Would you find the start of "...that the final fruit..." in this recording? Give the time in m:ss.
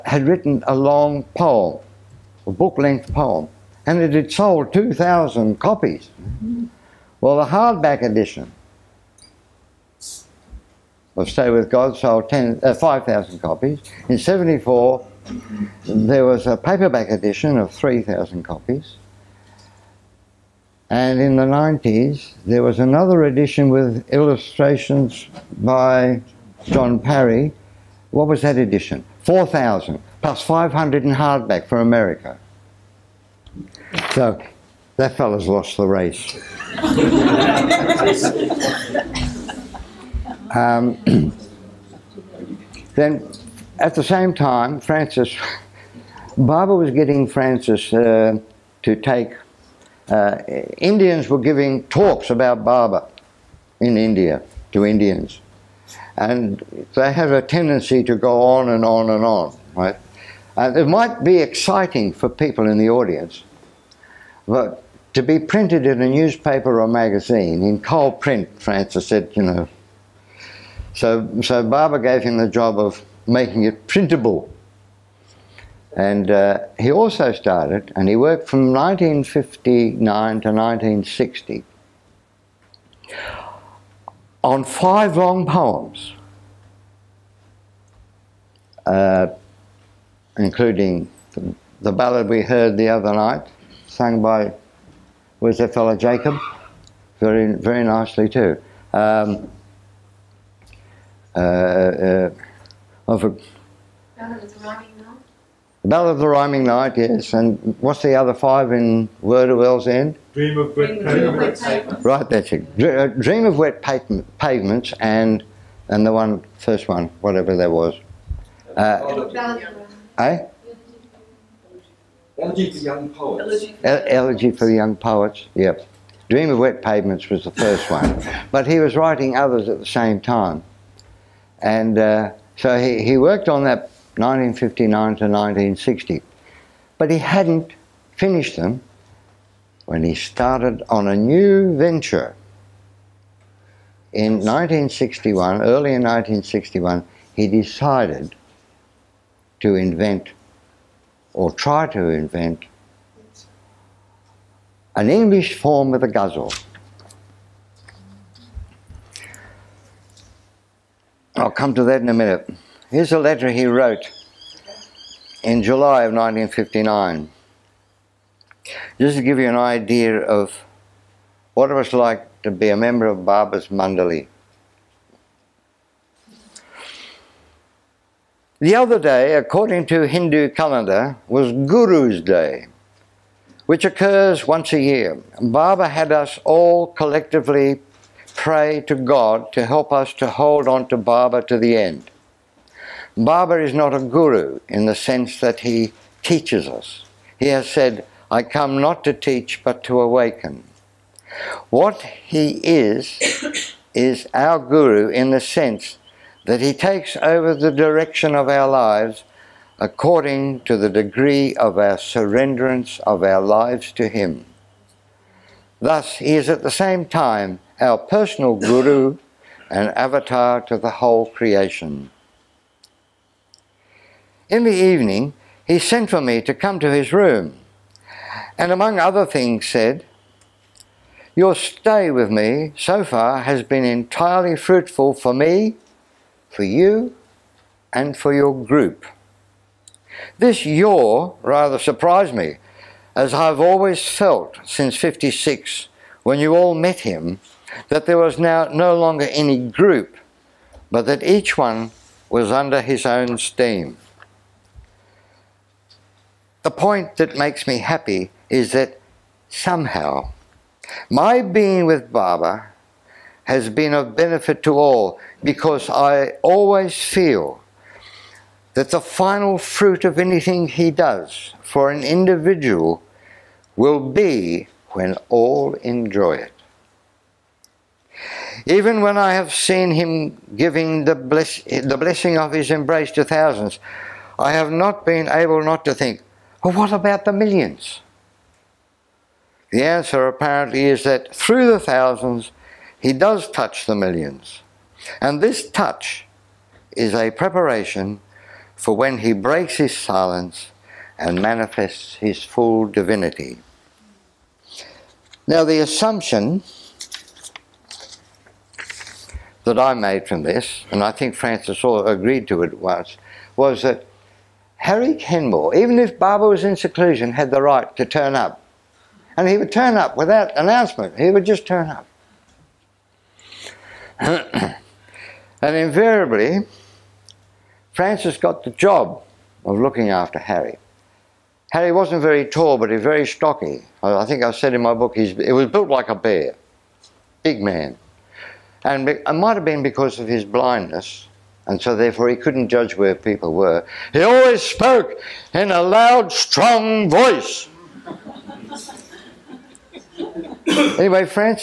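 4:28.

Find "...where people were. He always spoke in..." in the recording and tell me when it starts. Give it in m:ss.
5:42.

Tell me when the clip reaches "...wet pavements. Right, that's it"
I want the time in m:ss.
1:50.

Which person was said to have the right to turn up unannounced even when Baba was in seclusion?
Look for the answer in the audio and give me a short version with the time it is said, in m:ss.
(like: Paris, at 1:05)
Harry Kenmore, at 5:14.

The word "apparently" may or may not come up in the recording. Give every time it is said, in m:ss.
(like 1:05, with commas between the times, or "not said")
4:50.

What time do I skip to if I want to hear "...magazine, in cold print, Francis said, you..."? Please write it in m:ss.
1:06.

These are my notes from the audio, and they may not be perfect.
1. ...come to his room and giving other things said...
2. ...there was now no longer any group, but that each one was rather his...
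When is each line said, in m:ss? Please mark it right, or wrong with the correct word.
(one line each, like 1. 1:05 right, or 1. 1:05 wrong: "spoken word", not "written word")
1. 3:46 wrong: "among", not "giving"
2. 4:08 wrong: "under", not "rather".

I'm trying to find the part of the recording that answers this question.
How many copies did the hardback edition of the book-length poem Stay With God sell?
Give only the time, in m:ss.
0:12.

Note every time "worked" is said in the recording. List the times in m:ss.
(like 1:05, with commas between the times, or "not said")
1:18, 2:13.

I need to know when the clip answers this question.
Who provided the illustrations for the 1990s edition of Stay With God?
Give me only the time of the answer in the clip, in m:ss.
0:26.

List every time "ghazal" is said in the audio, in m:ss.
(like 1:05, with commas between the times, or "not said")
2:36.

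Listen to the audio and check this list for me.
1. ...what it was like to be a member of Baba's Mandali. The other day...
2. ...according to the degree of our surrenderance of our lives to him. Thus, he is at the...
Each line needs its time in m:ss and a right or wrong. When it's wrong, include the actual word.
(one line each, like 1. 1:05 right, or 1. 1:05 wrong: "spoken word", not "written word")
1. 2:51 right
2. 3:29 right.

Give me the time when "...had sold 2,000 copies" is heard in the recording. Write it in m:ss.
0:04.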